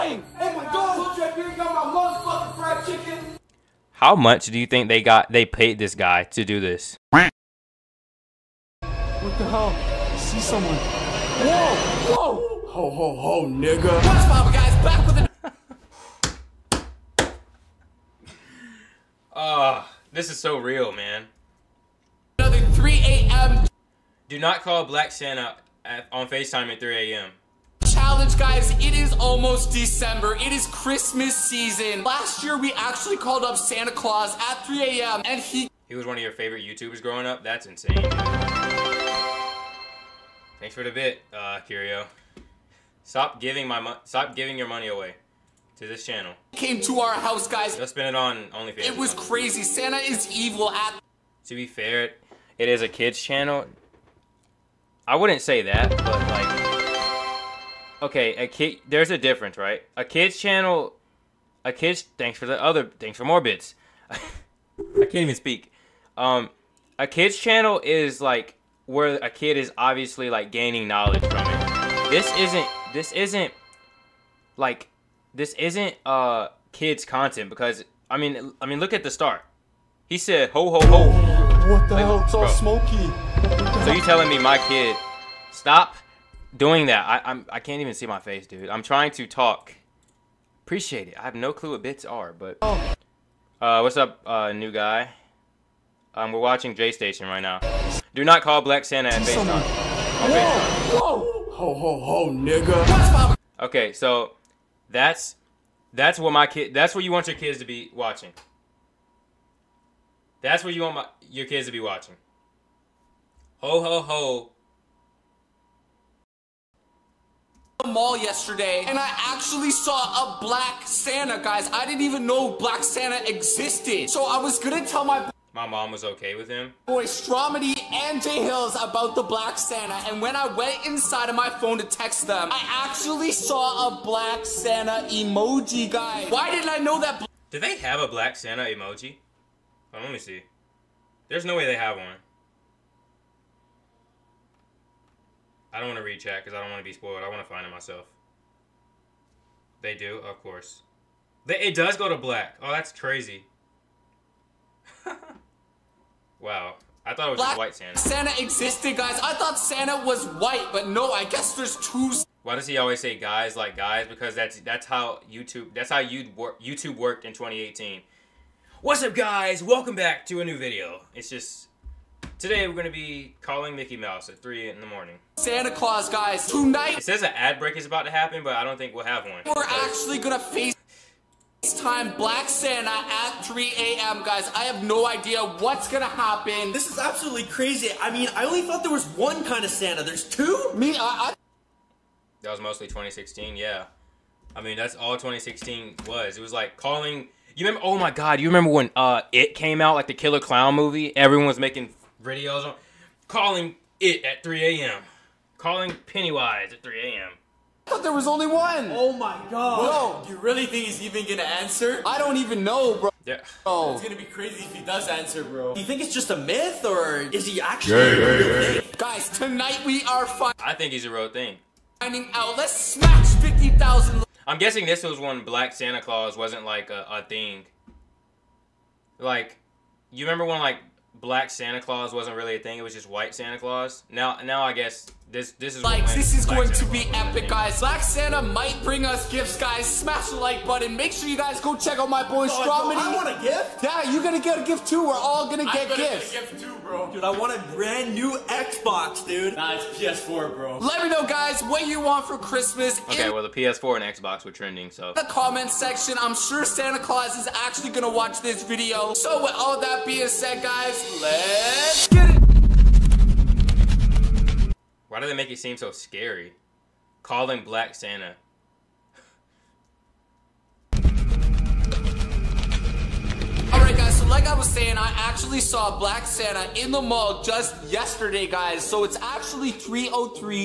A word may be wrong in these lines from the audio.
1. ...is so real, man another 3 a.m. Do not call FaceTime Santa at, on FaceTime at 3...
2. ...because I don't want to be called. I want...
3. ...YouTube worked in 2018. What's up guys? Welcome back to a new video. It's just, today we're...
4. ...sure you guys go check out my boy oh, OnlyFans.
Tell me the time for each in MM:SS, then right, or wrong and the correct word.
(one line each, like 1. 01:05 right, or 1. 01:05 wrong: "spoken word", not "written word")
1. 00:20 wrong: "Black", not "FaceTime"
2. 02:26 wrong: "spoiled", not "called"
3. 02:46 right
4. 04:01 wrong: "Stromedy", not "OnlyFans".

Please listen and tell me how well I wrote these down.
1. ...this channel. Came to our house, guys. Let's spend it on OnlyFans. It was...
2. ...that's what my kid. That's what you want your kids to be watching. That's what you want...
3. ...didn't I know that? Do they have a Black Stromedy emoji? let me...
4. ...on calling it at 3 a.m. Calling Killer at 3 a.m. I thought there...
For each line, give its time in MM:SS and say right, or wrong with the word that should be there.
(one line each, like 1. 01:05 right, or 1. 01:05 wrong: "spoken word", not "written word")
1. 00:45 right
2. 01:45 right
3. 02:16 wrong: "Santa", not "Stromedy"
4. 03:22 wrong: "Pennywise", not "Killer".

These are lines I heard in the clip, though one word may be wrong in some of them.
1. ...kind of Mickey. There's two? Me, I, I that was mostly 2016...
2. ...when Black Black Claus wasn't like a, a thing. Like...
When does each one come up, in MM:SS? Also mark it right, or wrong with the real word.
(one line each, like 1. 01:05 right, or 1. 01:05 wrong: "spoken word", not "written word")
1. 03:09 wrong: "Santa", not "Mickey"
2. 03:45 wrong: "Santa", not "Black".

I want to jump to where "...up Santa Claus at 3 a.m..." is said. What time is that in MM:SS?
00:33.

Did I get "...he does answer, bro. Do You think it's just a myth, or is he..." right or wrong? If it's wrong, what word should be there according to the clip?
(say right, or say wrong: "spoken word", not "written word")
right.